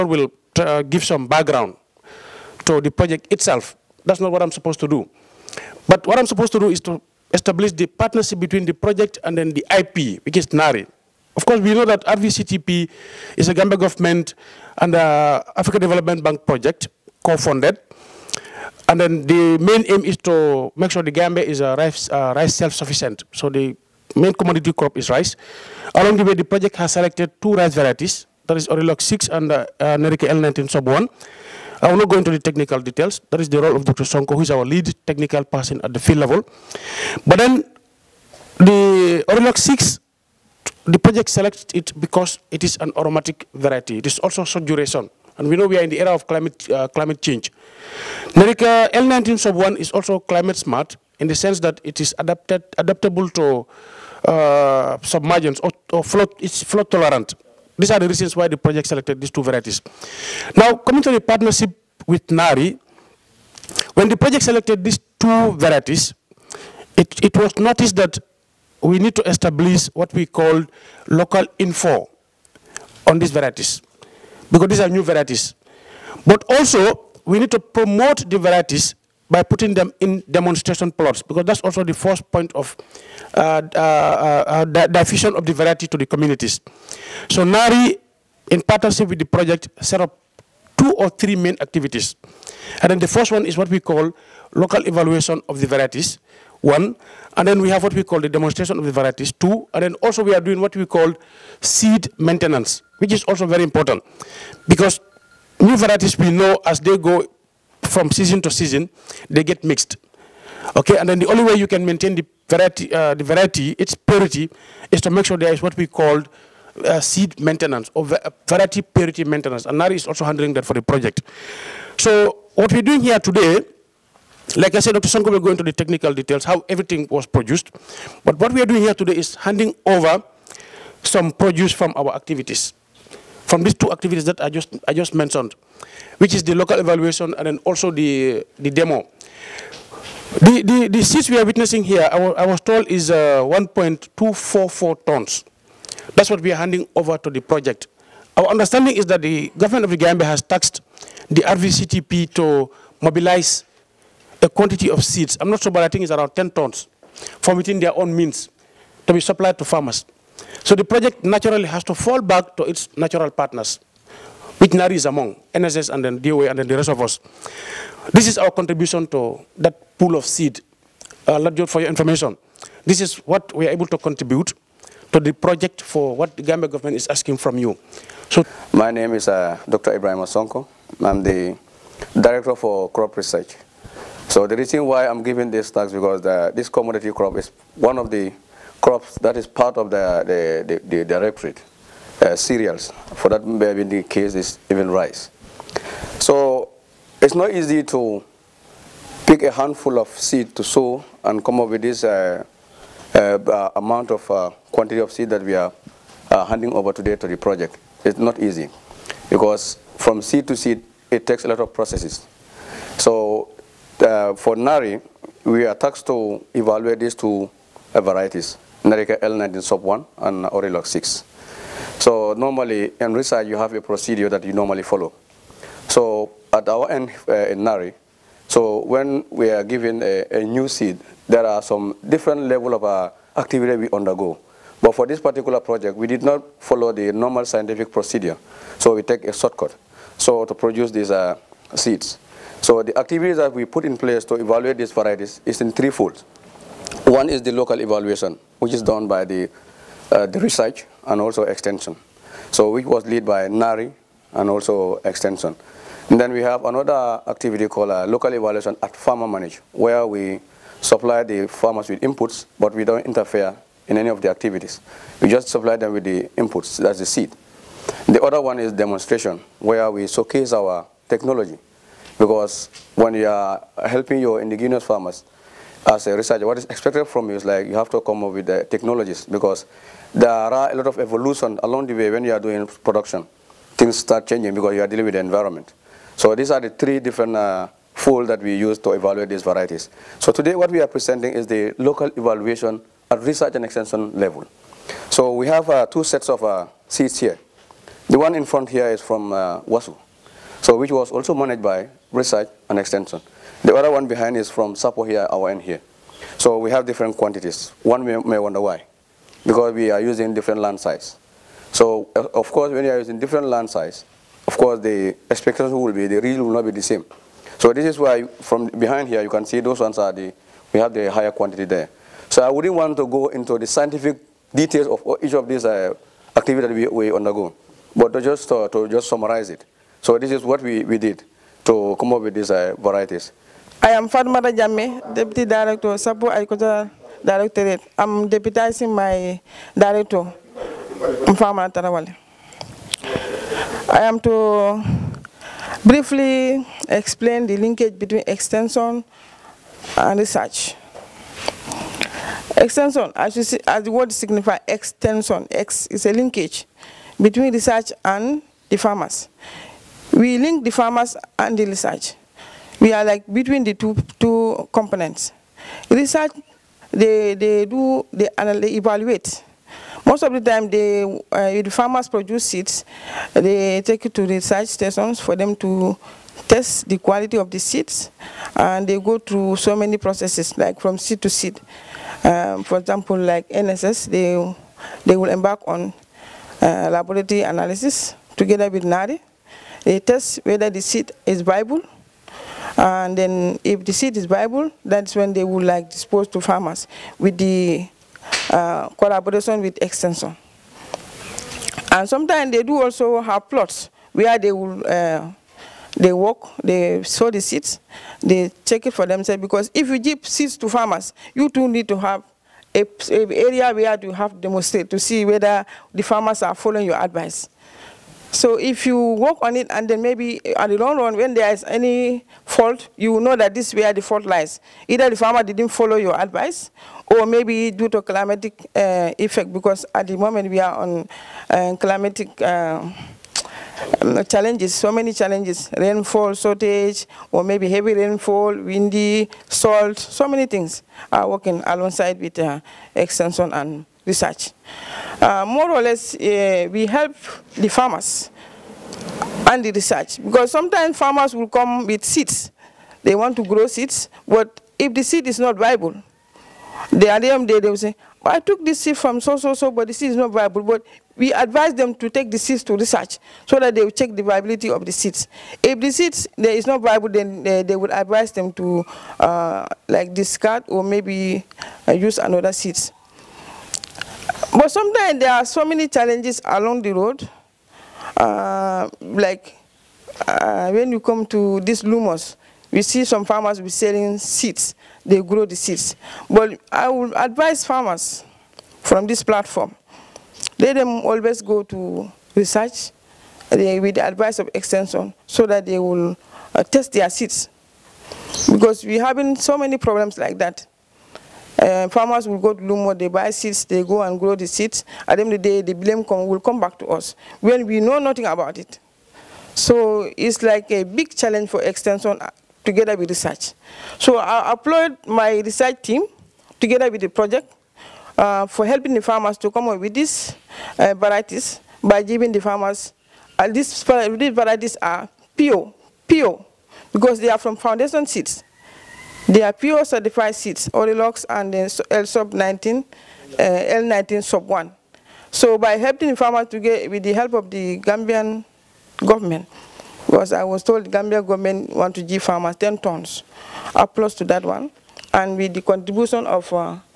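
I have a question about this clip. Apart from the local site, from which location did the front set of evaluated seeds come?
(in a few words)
WASU.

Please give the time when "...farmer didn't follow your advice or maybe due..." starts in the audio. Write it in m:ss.
7:05.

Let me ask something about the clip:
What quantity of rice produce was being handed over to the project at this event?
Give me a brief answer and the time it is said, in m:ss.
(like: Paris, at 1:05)
1.244 tons, at 2:23.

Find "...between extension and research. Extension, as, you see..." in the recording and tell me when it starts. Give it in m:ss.
5:47.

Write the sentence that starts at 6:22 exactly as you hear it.
Um, for example, like NSS, they, they will embark on uh, laboratory analysis together with NARI.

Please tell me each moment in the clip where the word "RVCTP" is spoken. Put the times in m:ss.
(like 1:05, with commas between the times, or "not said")
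0:12, 2:31.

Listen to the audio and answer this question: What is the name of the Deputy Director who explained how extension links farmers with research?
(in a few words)
Fatmata Jamme.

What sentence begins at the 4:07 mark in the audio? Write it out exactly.
One is the local evaluation, which is done by the, uh, the research and also extension.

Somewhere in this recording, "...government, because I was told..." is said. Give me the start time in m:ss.
8:58.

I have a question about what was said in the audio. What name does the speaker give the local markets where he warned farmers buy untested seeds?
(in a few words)
Lumos.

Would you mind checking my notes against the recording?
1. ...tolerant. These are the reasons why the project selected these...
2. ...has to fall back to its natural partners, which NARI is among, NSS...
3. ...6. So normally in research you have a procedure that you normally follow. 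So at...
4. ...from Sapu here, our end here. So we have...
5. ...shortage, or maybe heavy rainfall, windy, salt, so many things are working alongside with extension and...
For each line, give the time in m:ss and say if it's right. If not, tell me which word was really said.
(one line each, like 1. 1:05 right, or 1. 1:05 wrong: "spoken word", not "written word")
1. 0:56 right
2. 2:41 right
3. 3:40 right
4. 5:04 right
5. 7:16 right.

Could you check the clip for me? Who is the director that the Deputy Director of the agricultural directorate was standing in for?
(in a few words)
Mfama Tarawale.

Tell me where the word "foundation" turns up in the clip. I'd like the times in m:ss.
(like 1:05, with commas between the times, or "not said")
8:47.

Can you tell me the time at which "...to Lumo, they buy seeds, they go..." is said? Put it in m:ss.
8:22.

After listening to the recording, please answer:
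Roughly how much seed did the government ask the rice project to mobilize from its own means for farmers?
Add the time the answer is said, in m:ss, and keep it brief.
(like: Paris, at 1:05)
10 tons, at 2:36.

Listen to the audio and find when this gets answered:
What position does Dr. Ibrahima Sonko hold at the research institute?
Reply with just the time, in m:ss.
3:02.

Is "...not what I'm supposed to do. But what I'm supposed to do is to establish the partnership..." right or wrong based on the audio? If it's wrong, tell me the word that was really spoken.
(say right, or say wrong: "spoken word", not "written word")
right.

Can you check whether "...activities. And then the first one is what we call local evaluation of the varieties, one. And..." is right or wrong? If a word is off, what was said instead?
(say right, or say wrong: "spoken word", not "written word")
right.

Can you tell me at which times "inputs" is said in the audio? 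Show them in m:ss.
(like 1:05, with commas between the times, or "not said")
4:22, 4:26.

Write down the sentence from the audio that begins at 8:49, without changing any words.
They are pure certified seeds, Orylux and L sub 19, uh, L19 sub 1.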